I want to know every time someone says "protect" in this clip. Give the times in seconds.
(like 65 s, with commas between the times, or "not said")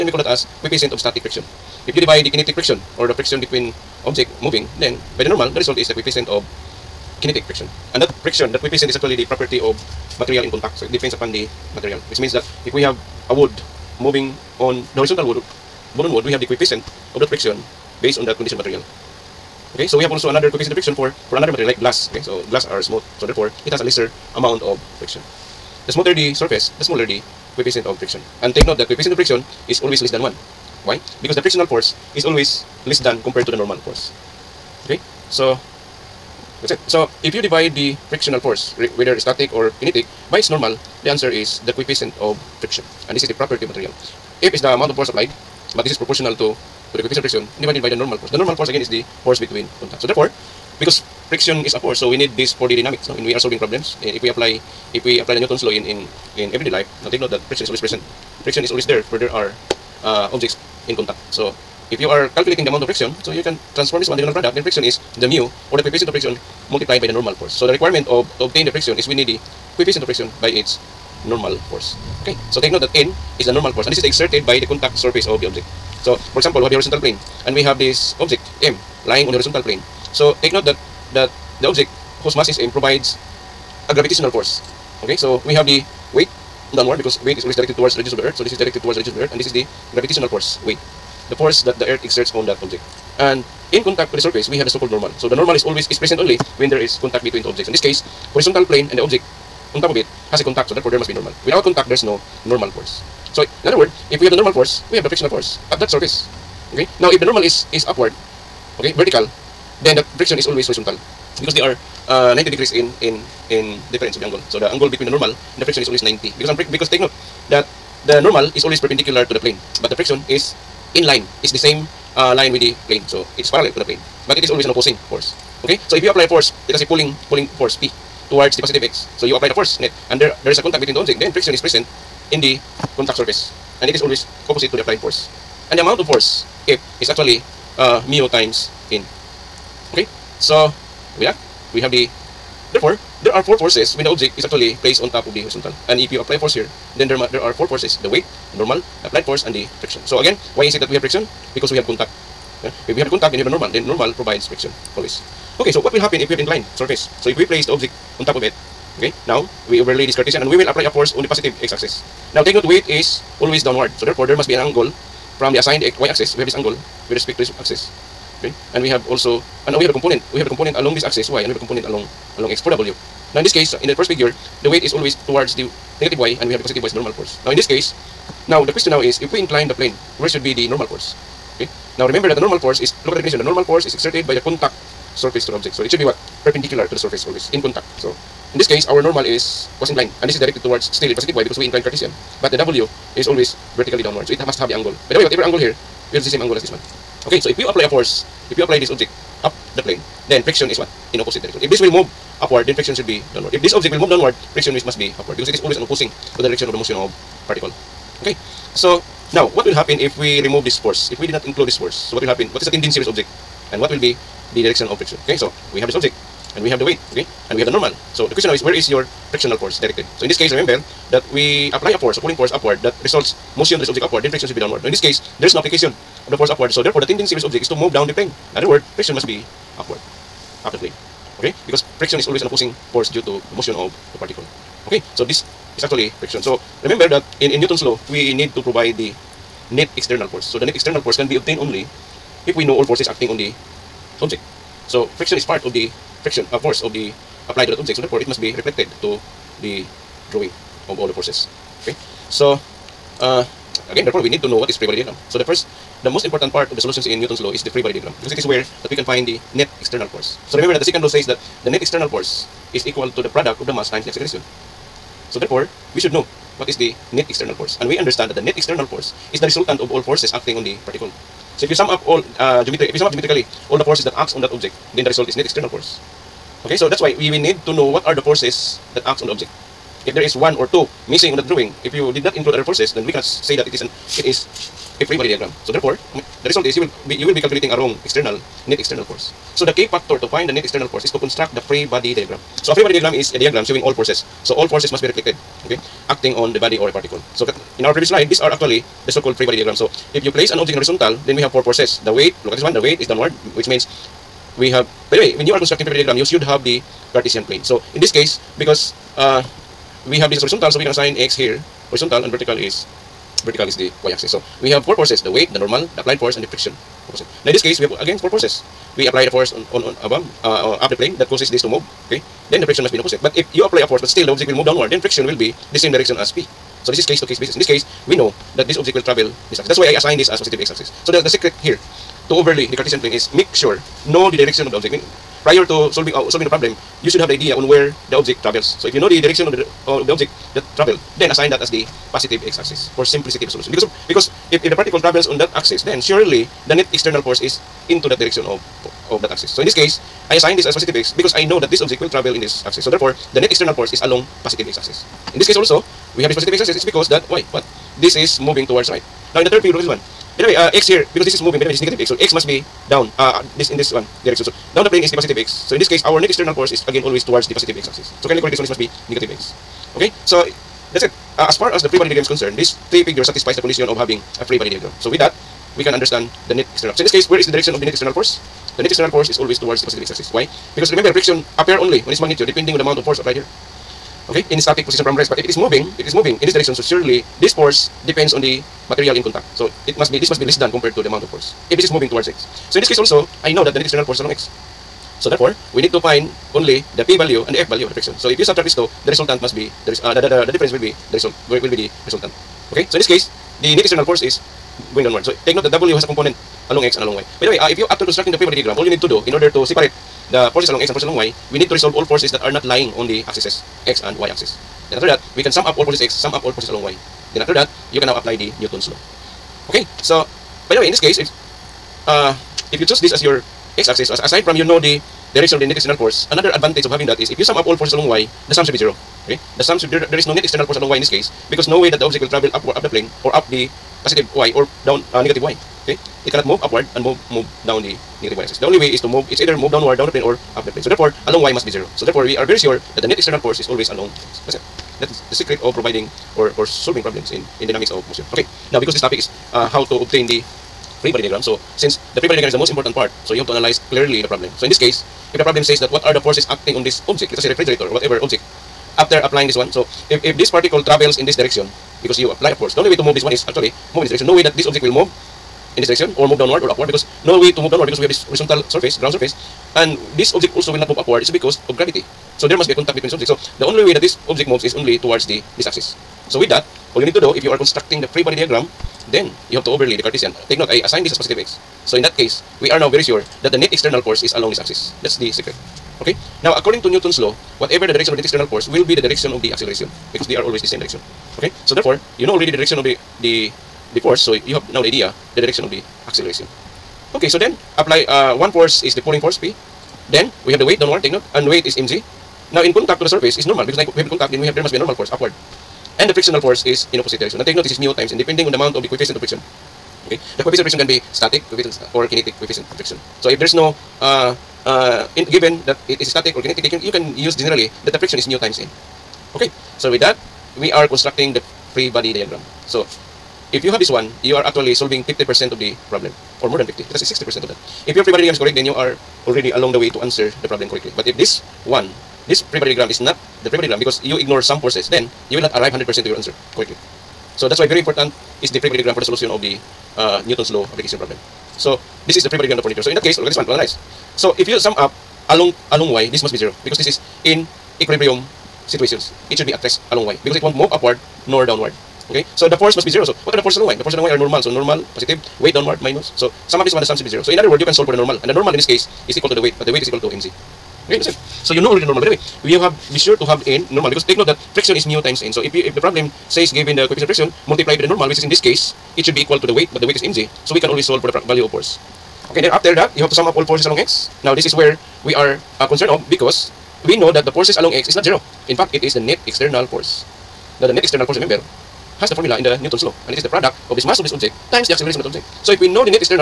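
not said.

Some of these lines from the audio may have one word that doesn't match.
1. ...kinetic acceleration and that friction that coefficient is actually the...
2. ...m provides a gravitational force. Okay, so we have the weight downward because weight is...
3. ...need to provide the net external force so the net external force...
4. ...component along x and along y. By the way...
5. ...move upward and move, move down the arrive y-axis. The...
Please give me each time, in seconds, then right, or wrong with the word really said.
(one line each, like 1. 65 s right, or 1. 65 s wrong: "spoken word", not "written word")
1. 7 s wrong: "friction", not "acceleration"
2. 82 s right
3. 238 s right
4. 406 s right
5. 436 s wrong: "negative", not "arrive".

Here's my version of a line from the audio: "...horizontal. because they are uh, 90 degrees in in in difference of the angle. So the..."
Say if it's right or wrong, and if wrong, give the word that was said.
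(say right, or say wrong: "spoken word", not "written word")
right.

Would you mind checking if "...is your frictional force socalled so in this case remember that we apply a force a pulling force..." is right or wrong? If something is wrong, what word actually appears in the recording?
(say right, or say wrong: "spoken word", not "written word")
wrong: "directed", not "socalled".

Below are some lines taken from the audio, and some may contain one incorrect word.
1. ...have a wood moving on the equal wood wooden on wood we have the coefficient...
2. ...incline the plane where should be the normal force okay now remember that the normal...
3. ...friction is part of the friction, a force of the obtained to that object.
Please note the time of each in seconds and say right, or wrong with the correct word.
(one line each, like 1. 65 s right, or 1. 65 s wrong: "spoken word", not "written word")
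1. 12 s wrong: "horizontal", not "equal"
2. 179 s right
3. 245 s wrong: "applied", not "obtained".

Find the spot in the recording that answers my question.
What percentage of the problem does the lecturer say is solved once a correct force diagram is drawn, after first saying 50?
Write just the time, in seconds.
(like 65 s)
527 s.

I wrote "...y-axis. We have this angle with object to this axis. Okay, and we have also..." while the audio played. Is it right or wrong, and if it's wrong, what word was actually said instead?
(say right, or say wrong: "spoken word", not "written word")
wrong: "respect", not "object".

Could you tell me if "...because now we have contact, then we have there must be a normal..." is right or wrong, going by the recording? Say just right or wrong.
right.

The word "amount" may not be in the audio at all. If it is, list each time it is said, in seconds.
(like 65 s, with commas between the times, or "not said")
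24 s, 44 s, 62 s, 135 s, 382 s, 391 s, 508 s.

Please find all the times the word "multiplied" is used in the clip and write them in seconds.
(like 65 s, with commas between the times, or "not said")
66 s, 567 s.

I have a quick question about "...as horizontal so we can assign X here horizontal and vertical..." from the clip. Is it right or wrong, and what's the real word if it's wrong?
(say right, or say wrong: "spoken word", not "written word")
right.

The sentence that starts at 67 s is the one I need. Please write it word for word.
So the requirement of to obtain the friction is we need the coefficient of friction by its normal force.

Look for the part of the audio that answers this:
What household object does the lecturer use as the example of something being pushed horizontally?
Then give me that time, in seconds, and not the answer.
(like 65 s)
457 s.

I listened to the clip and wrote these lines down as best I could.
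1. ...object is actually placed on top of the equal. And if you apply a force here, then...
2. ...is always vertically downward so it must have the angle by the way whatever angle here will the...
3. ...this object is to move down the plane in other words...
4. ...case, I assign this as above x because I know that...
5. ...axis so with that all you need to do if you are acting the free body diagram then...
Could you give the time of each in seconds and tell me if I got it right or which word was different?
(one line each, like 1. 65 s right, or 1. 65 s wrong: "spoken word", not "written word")
1. 144 s wrong: "horizontal", not "equal"
2. 193 s right
3. 227 s right
4. 349 s wrong: "positive", not "above"
5. 475 s wrong: "constructing", not "acting".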